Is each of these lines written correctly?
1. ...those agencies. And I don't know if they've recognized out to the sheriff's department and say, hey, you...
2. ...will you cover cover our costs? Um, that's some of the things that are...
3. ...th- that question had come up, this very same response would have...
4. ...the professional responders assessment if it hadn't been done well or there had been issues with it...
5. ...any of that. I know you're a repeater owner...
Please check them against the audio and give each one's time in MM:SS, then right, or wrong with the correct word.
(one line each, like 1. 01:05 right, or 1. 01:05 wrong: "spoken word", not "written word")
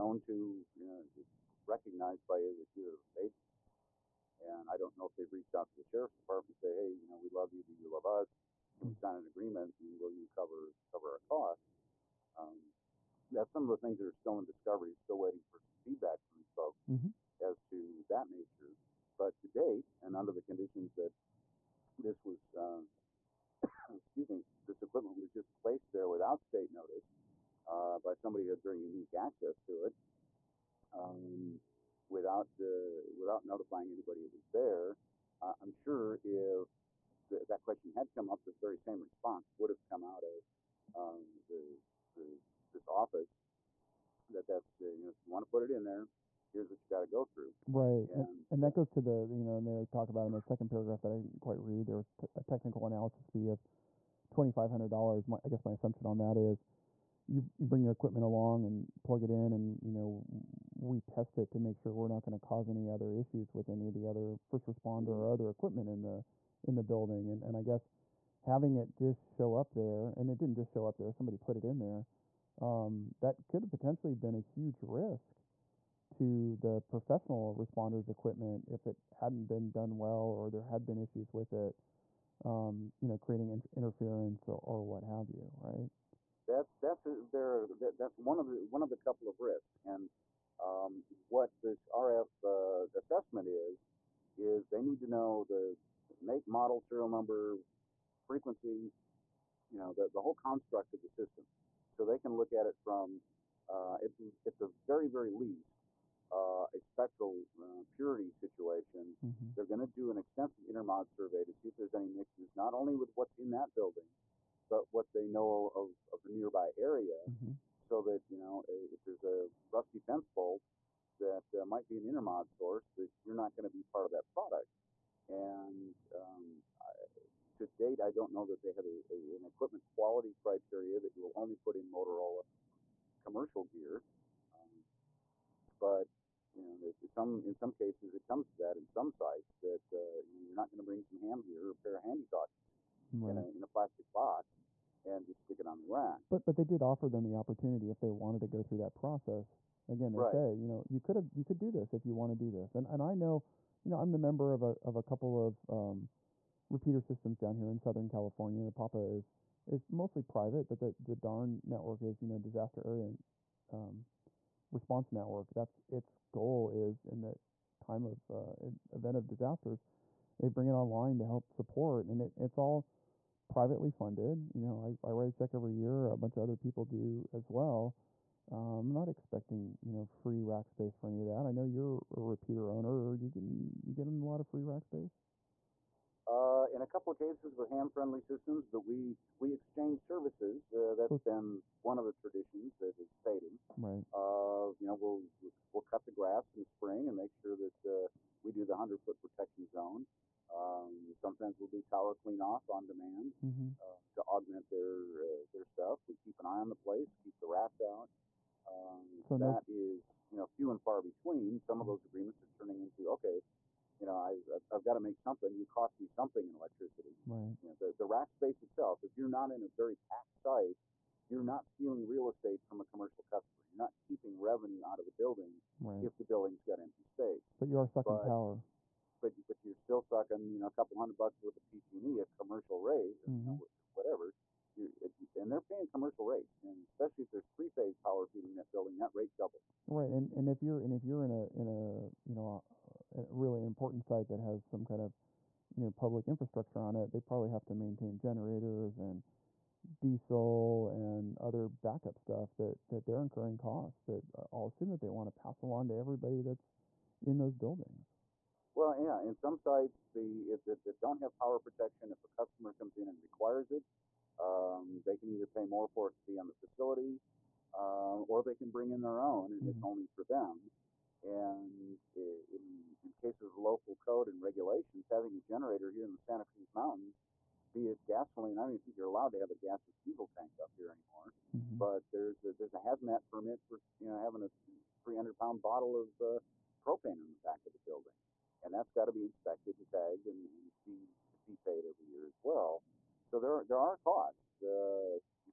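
1. 00:03 wrong: "reached", not "recognized"
2. 00:09 right
3. 00:37 right
4. 01:16 wrong: "equipment", not "assessment"
5. 03:01 right.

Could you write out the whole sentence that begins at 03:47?
But you are sucking but, power.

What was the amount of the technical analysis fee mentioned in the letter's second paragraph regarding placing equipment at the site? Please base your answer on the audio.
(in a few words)
$2,500.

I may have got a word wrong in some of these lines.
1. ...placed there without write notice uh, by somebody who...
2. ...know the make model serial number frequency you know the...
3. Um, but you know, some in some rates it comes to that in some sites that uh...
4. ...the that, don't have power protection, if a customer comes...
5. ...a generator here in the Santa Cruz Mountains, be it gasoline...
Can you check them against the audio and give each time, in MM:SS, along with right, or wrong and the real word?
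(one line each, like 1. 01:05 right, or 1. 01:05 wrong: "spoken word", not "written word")
1. 00:25 wrong: "state", not "write"
2. 01:35 right
3. 02:14 wrong: "cases", not "rates"
4. 04:20 right
5. 04:35 right.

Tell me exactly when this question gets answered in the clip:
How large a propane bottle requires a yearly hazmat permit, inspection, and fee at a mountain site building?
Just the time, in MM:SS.
04:45.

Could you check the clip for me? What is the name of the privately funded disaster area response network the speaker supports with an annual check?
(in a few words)
DARN.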